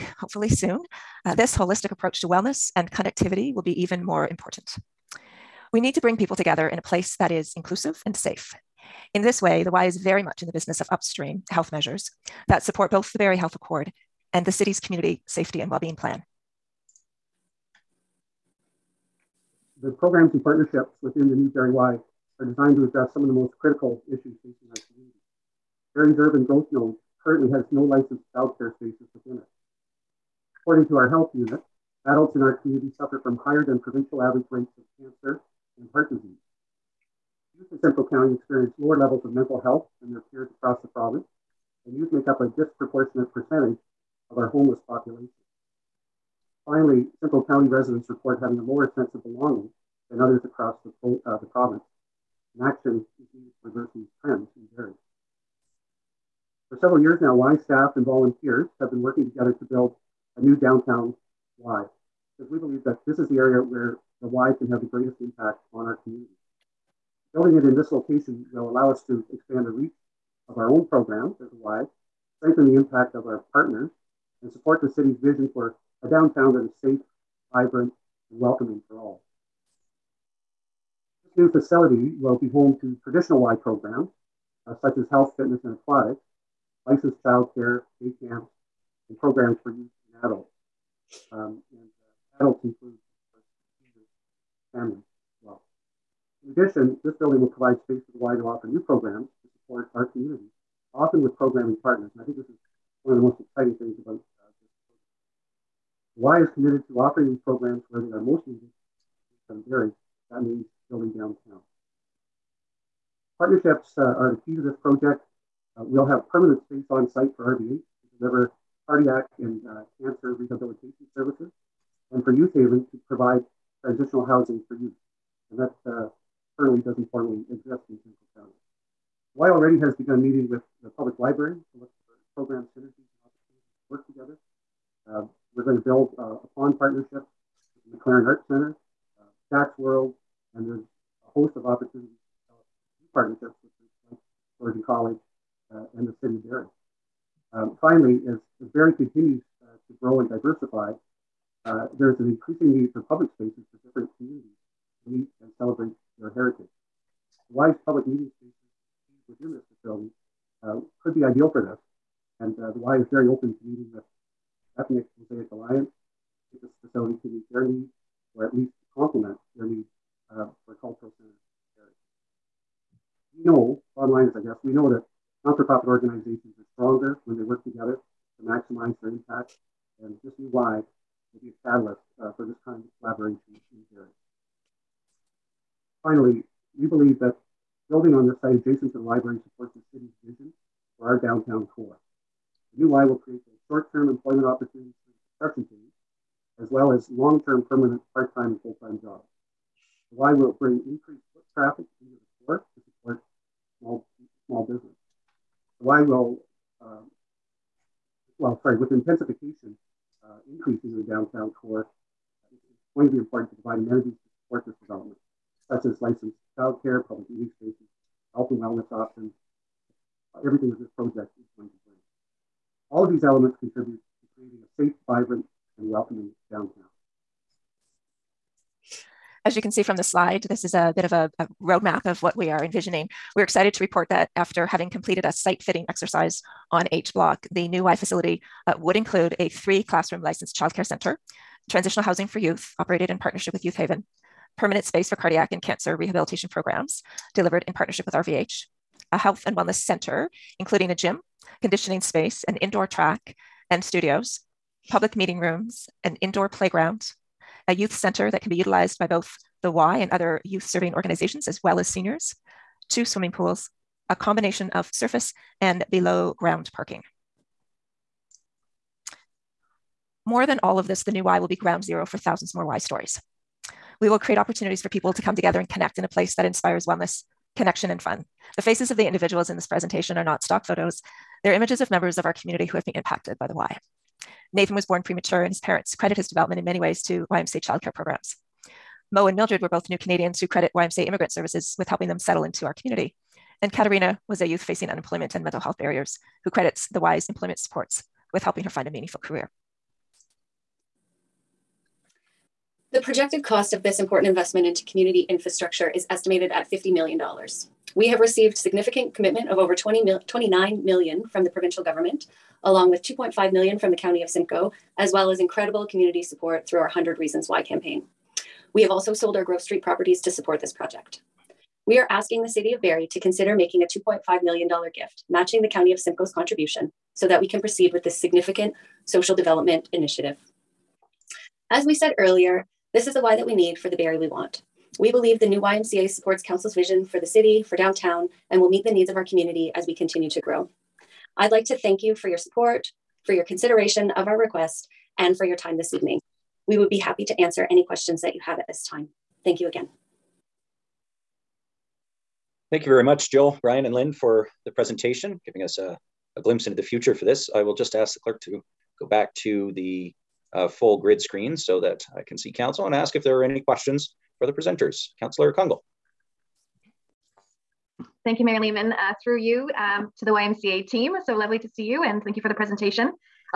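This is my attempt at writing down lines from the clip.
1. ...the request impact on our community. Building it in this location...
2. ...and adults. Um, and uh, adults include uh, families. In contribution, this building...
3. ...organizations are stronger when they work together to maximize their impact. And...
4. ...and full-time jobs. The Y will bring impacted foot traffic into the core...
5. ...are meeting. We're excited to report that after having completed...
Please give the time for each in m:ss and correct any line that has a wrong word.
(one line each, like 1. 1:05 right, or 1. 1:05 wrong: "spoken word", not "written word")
1. 1:04 wrong: "greatest", not "request"
2. 1:30 wrong: "addition", not "contribution"
3. 2:55 right
4. 3:18 wrong: "increased", not "impacted"
5. 3:52 wrong: "envisioning", not "meeting".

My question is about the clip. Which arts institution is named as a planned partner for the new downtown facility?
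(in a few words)
MacLaren Arts Center.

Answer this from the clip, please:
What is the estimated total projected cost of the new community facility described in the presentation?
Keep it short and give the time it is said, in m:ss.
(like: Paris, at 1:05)
$50 million, at 5:06.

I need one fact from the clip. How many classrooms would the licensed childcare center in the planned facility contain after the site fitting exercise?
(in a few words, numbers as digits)
3.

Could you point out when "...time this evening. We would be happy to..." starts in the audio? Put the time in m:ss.
5:45.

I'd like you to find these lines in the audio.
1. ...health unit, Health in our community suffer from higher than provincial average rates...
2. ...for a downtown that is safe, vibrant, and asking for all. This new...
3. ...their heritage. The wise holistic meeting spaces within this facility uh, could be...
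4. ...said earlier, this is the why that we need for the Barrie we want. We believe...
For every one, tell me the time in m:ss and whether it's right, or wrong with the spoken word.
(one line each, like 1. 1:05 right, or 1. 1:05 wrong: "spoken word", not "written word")
1. 0:31 wrong: "Adults", not "Health"
2. 1:15 wrong: "welcoming", not "asking"
3. 2:36 wrong: "public", not "holistic"
4. 5:31 right.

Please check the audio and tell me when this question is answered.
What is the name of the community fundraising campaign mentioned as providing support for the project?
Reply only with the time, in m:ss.
5:16.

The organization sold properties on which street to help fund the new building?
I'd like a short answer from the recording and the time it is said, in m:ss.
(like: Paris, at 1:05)
Grove Street, at 5:19.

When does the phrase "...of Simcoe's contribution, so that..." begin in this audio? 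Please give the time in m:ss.
5:25.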